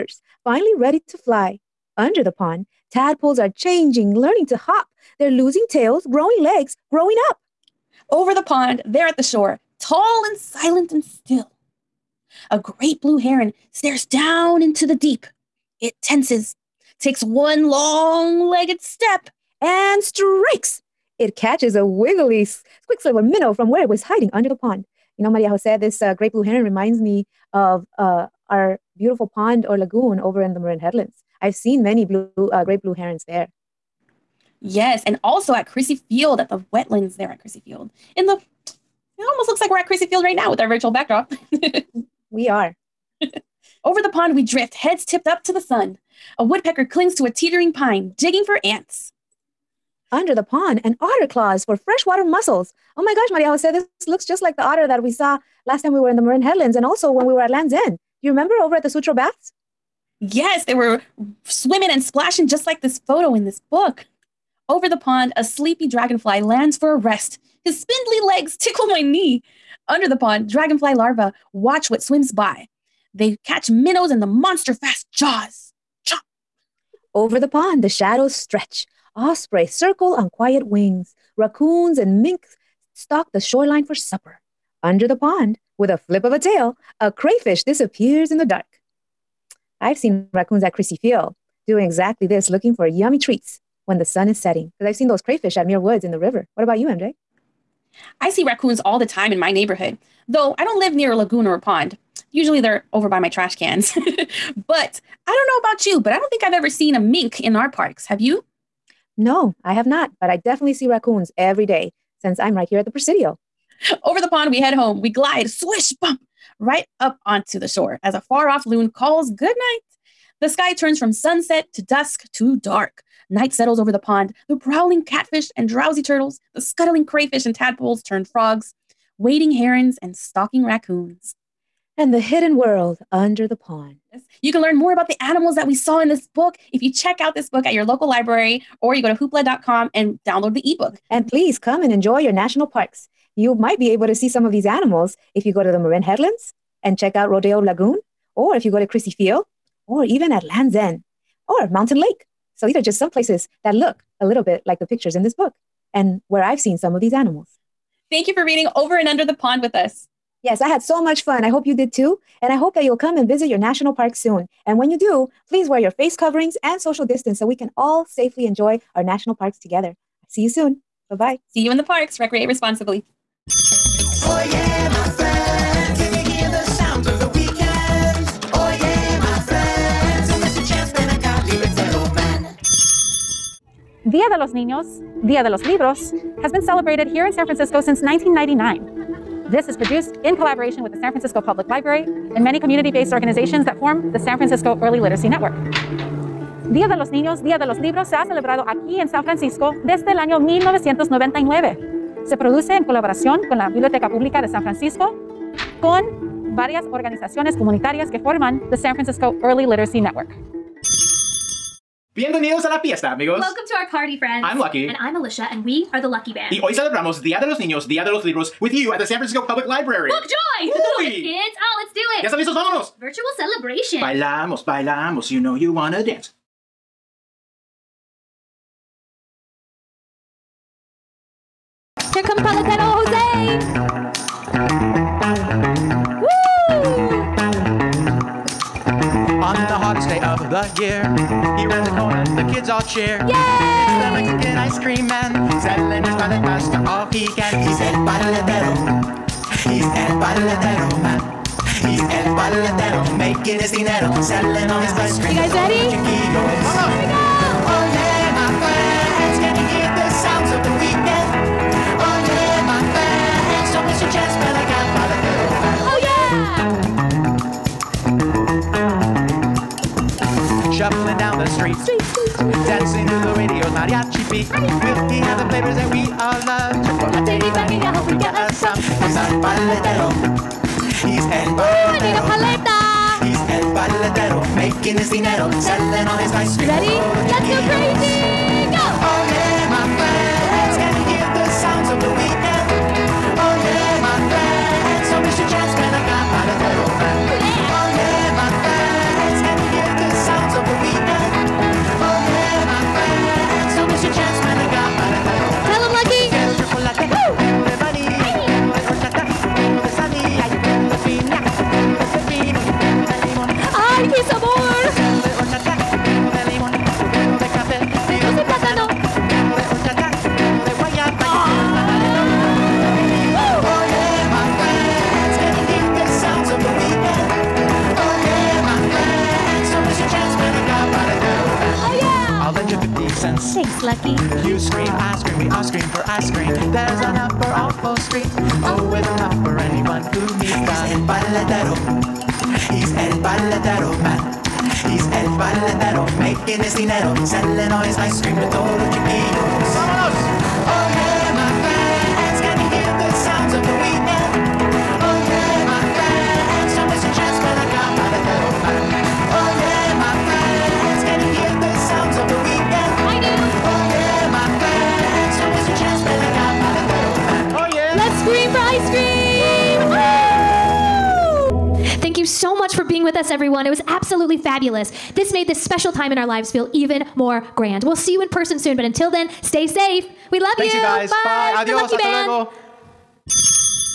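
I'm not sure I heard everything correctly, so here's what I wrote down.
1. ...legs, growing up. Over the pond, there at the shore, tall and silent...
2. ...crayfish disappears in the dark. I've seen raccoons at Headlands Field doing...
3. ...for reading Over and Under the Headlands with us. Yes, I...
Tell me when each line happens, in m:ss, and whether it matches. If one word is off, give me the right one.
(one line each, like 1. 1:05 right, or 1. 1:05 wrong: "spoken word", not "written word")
1. 0:06 right
2. 1:27 wrong: "Crissy", not "Headlands"
3. 2:38 wrong: "Pond", not "Headlands".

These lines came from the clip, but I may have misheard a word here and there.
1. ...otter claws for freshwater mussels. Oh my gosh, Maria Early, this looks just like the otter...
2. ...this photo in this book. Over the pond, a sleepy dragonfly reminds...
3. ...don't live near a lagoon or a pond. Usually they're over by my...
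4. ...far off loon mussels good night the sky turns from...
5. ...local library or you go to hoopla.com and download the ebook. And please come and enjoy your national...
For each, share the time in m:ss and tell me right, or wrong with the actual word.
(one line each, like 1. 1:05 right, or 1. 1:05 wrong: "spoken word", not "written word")
1. 0:50 wrong: "Jose", not "Early"
2. 1:02 wrong: "lands", not "reminds"
3. 1:40 right
4. 1:58 wrong: "calls", not "mussels"
5. 2:17 right.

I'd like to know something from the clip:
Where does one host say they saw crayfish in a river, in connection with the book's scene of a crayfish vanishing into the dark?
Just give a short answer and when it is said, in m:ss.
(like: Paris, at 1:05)
Muir Woods, at 1:35.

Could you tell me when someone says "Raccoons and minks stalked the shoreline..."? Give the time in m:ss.
1:21.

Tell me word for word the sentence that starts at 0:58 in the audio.
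Do you remember over at the Sutro Baths?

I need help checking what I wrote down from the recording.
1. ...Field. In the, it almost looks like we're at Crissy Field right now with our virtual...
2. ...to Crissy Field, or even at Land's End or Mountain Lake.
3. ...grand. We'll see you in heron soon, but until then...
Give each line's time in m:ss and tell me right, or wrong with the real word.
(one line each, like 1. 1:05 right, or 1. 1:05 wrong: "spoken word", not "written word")
1. 0:37 right
2. 2:28 right
3. 6:17 wrong: "person", not "heron".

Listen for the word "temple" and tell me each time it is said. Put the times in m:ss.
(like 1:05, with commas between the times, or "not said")
not said.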